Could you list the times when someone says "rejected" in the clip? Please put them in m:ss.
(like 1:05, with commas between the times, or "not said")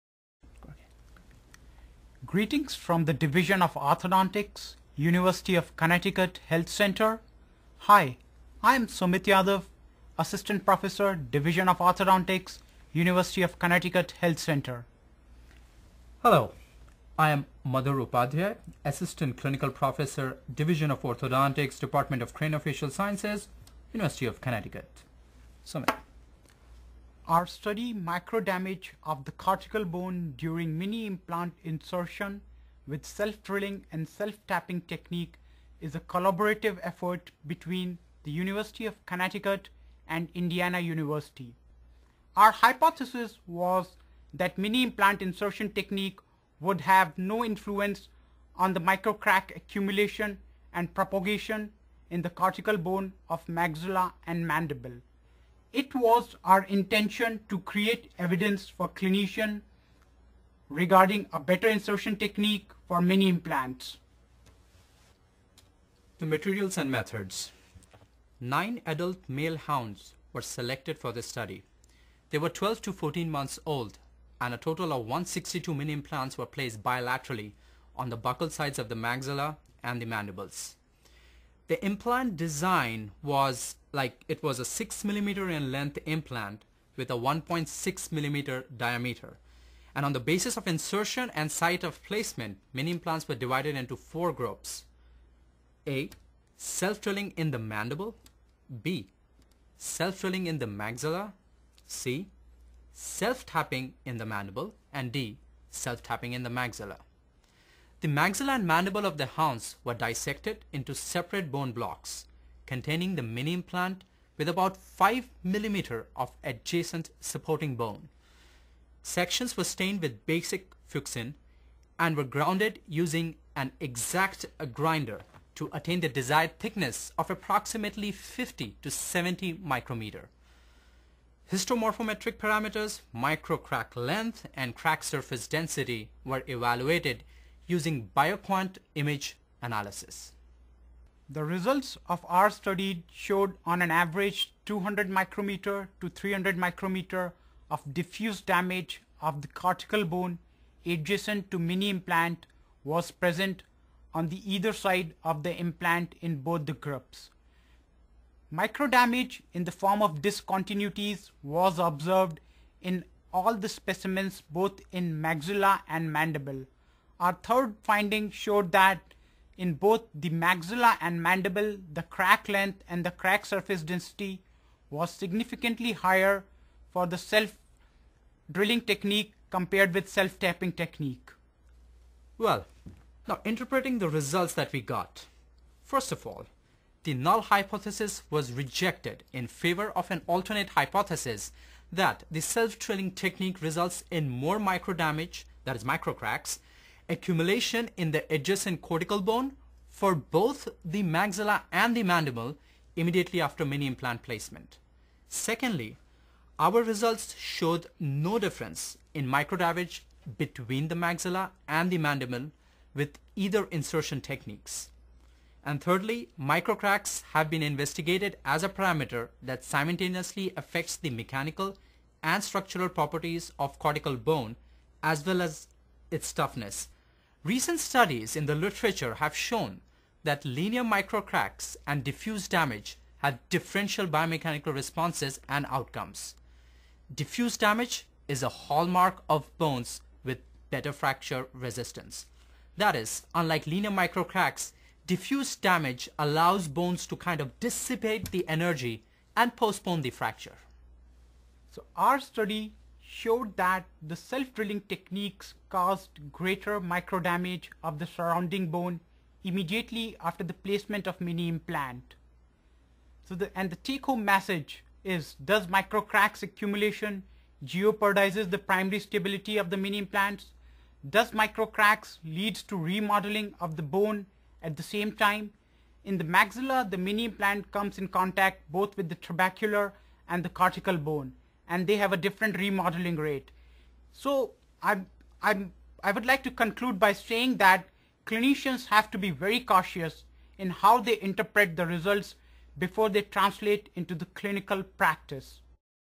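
3:08.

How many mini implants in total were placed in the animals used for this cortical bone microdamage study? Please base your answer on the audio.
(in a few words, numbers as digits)
162.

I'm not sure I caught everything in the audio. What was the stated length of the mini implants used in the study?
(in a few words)
6 millimeters.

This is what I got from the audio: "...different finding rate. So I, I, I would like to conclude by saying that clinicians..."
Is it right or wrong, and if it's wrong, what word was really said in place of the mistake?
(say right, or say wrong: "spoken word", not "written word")
wrong: "remodeling", not "finding".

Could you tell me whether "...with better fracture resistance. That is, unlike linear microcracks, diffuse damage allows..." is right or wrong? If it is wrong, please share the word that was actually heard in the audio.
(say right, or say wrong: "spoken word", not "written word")
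right.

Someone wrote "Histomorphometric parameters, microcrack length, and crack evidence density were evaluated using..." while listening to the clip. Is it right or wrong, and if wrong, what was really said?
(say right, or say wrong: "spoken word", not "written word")
wrong: "surface", not "evidence".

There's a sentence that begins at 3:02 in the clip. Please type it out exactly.
Well, now interpreting the results that we got.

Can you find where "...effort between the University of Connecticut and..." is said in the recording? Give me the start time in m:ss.
0:36.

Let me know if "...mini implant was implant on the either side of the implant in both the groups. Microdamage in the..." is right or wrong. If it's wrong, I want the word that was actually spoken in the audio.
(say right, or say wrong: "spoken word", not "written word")
wrong: "present", not "implant".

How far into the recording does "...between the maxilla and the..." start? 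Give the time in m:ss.
3:30.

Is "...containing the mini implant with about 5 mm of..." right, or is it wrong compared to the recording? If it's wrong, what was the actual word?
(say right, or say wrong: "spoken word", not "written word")
right.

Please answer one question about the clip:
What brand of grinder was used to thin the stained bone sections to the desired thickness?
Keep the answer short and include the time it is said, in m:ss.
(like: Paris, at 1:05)
Exakt, at 2:03.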